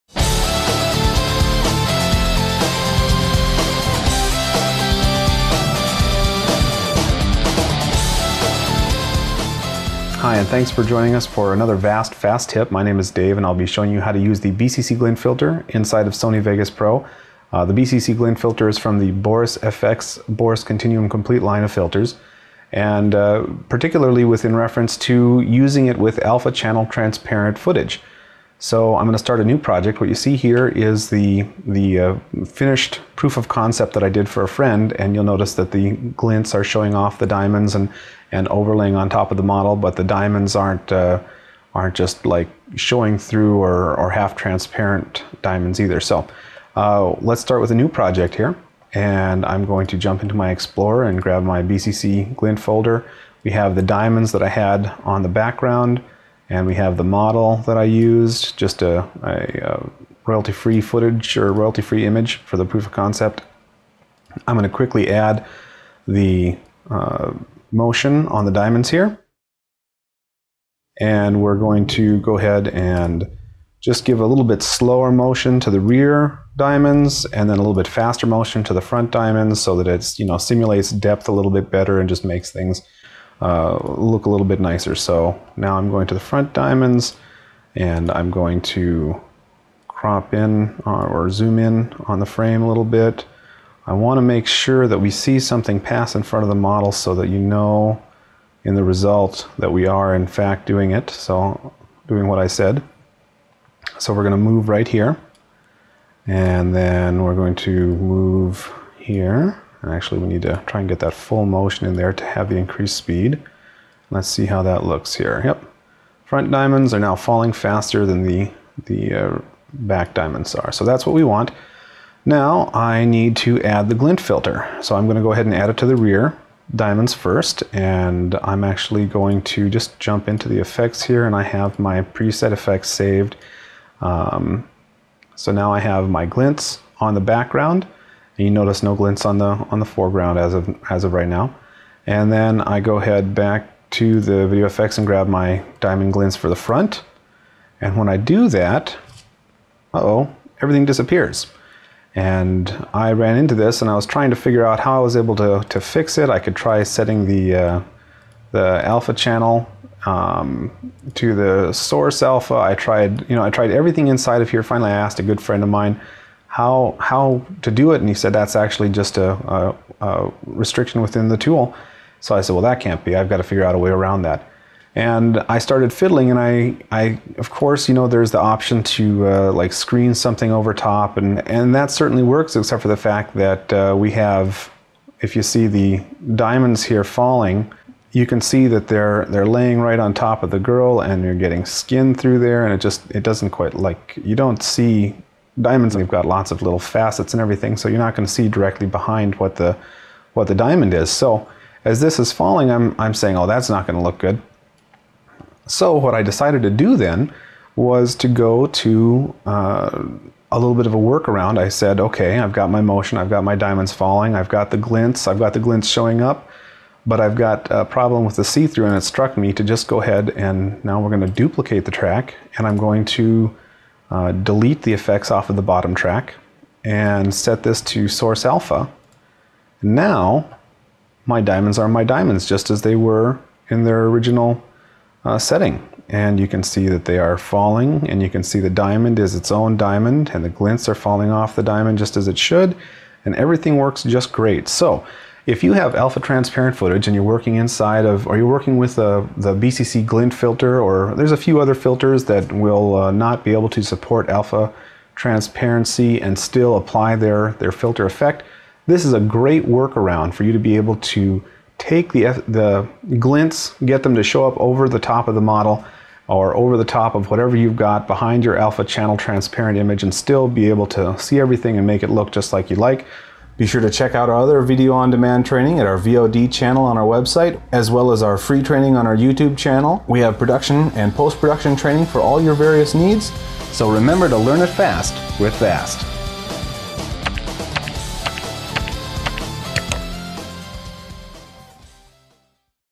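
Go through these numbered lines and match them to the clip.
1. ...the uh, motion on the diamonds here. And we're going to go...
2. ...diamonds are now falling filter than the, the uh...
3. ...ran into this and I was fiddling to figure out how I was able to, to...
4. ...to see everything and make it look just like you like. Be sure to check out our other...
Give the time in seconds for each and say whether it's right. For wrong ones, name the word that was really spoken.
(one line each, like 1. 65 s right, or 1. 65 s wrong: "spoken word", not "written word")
1. 66 s right
2. 116 s wrong: "faster", not "filter"
3. 153 s wrong: "trying", not "fiddling"
4. 270 s right.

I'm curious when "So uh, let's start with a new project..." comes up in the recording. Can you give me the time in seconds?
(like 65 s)
45 s.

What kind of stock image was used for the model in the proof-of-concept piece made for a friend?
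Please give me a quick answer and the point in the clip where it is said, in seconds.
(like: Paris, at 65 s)
royalty-free image, at 61 s.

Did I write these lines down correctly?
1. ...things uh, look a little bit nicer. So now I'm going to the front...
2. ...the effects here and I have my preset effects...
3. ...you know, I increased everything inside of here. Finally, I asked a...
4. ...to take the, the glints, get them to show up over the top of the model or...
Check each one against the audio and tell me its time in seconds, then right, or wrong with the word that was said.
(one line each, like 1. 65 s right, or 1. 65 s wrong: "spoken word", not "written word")
1. 82 s right
2. 130 s right
3. 163 s wrong: "tried", not "increased"
4. 260 s right.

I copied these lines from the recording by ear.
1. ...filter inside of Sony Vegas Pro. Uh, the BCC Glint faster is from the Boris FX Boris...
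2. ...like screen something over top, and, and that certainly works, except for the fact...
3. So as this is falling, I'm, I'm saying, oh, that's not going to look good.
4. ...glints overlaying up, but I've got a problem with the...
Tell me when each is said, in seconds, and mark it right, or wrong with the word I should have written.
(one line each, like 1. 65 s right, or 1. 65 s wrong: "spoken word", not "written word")
1. 15 s wrong: "filter", not "faster"
2. 179 s right
3. 201 s right
4. 215 s wrong: "showing", not "overlaying".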